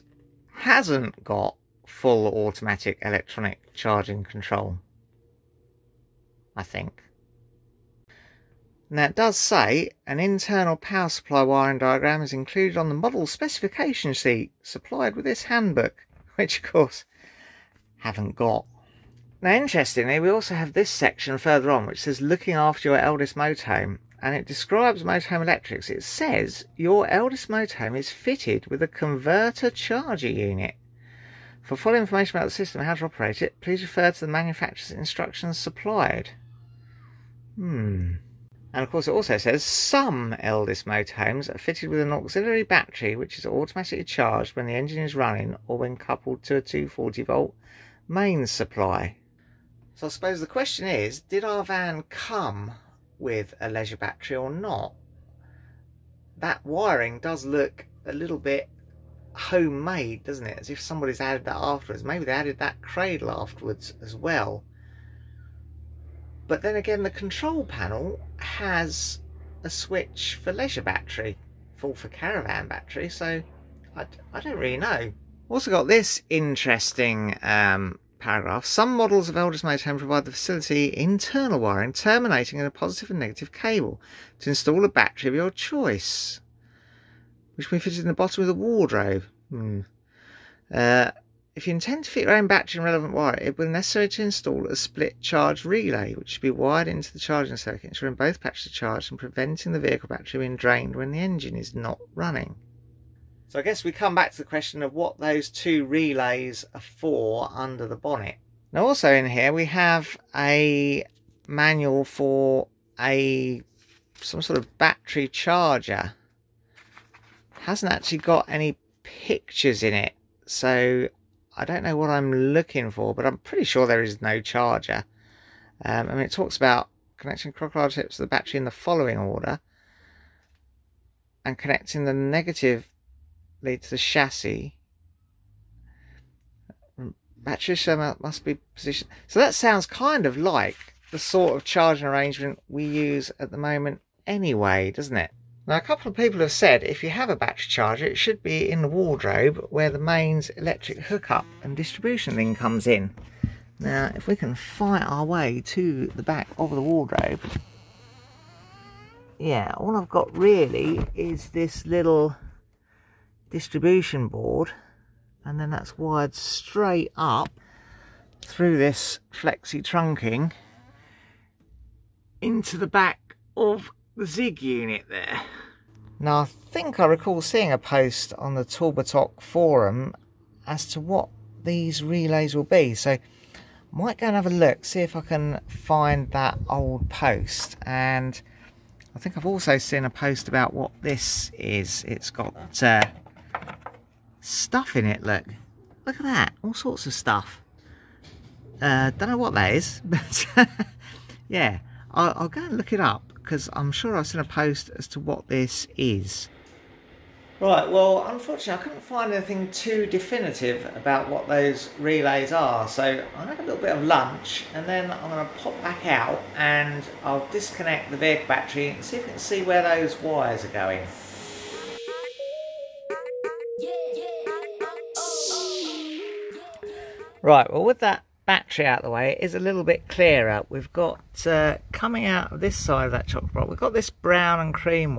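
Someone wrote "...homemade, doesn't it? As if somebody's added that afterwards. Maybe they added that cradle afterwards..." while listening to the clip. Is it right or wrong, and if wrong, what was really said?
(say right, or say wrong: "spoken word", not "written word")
right.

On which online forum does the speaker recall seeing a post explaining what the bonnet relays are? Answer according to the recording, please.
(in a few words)
Talbotoc forum.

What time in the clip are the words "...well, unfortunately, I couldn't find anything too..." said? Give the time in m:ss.
3:27.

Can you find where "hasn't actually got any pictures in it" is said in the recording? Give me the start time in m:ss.
1:57.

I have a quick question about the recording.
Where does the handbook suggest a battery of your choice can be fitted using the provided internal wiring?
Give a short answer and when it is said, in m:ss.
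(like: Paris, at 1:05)
Bottom of the wardrobe, at 1:28.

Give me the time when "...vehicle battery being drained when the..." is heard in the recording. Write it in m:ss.
1:39.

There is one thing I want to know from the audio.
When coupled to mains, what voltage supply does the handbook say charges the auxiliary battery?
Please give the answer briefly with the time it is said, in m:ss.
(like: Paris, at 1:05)
240 volt, at 0:46.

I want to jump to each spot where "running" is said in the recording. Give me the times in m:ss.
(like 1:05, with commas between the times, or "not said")
0:45, 1:42.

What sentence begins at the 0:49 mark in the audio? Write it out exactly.
So I suppose the question is, did our van come with a leisure battery or not?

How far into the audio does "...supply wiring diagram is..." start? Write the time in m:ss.
0:11.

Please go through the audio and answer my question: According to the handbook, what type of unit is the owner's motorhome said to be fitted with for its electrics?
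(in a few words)
Converter charger unit.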